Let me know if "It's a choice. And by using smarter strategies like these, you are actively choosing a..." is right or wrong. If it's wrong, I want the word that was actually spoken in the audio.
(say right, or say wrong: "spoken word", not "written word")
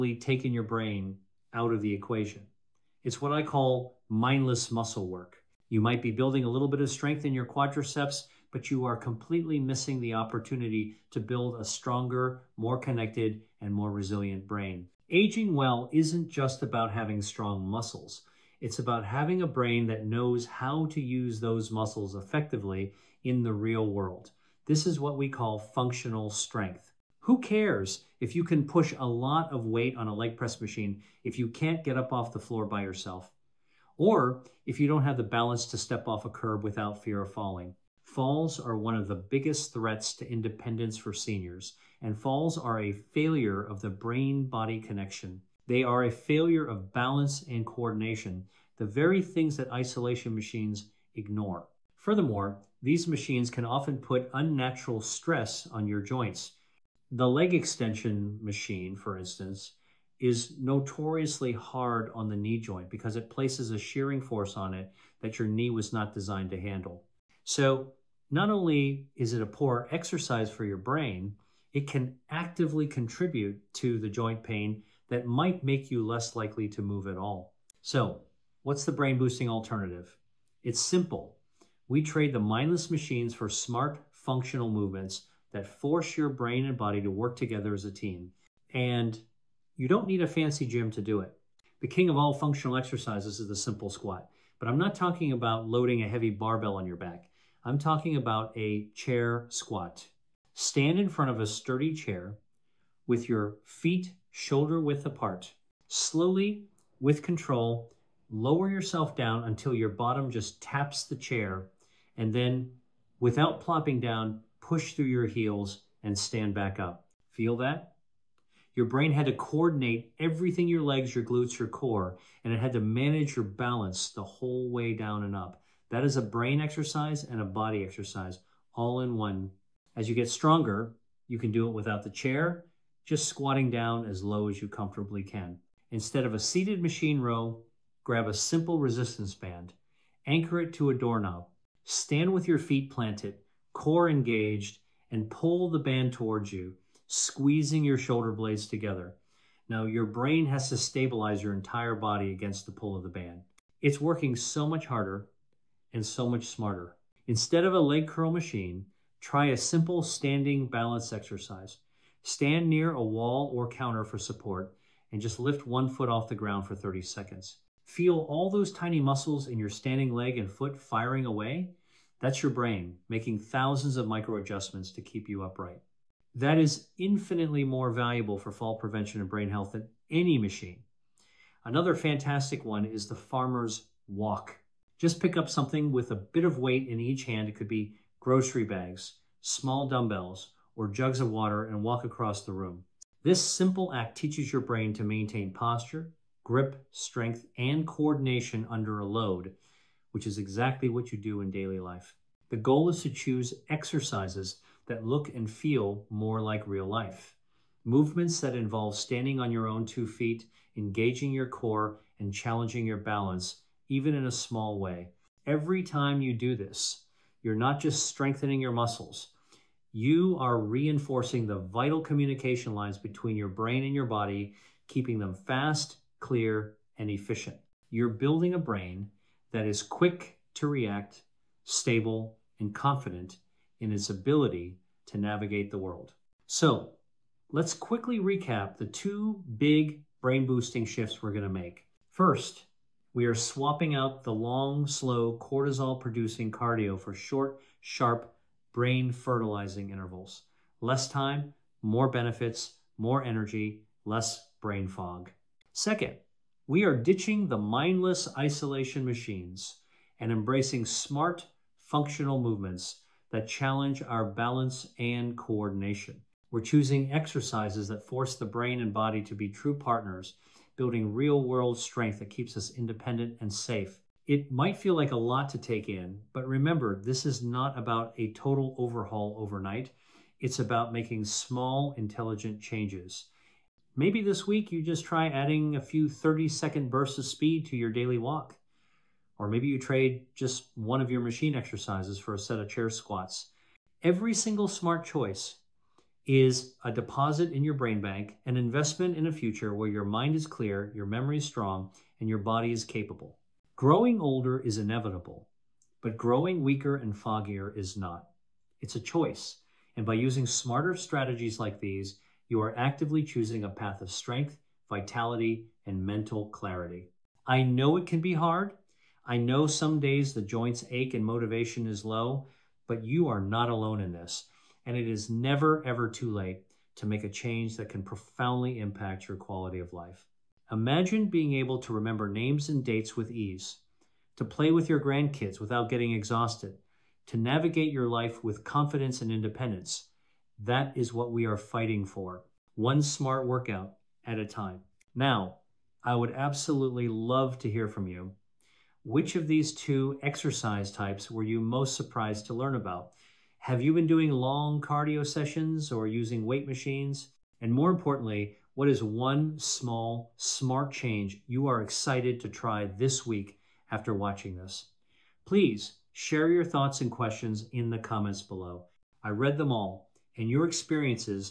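right.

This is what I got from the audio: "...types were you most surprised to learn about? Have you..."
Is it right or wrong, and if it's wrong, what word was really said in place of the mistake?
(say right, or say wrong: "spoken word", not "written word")
right.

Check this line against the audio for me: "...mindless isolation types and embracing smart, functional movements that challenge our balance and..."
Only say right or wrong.
wrong.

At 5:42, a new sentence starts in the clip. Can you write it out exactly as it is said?
One smart workout at a time.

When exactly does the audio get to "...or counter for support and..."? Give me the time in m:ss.
2:43.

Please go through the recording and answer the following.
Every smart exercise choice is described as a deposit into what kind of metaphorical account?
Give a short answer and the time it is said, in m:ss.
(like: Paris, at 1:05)
brain bank, at 4:57.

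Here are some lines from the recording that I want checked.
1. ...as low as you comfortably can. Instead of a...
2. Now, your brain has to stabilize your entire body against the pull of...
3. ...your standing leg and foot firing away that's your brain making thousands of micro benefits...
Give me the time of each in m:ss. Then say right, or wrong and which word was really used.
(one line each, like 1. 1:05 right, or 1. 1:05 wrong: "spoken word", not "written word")
1. 2:14 right
2. 2:29 right
3. 2:49 wrong: "adjustments", not "benefits".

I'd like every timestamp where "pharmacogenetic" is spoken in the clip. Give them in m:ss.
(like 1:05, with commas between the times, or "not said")
not said.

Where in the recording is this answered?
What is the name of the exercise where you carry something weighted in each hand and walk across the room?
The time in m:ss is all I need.
3:03.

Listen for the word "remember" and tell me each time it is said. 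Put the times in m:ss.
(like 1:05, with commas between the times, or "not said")
4:36, 5:31.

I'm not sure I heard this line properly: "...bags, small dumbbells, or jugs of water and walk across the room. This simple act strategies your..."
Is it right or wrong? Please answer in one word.
wrong.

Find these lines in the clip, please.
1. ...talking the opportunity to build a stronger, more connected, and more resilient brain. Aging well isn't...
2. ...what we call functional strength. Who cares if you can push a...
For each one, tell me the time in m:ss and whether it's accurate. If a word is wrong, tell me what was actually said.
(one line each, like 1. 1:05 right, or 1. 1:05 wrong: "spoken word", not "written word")
1. 0:09 wrong: "missing", not "talking"
2. 0:25 right.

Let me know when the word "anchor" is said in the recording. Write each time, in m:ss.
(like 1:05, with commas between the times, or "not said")
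2:20.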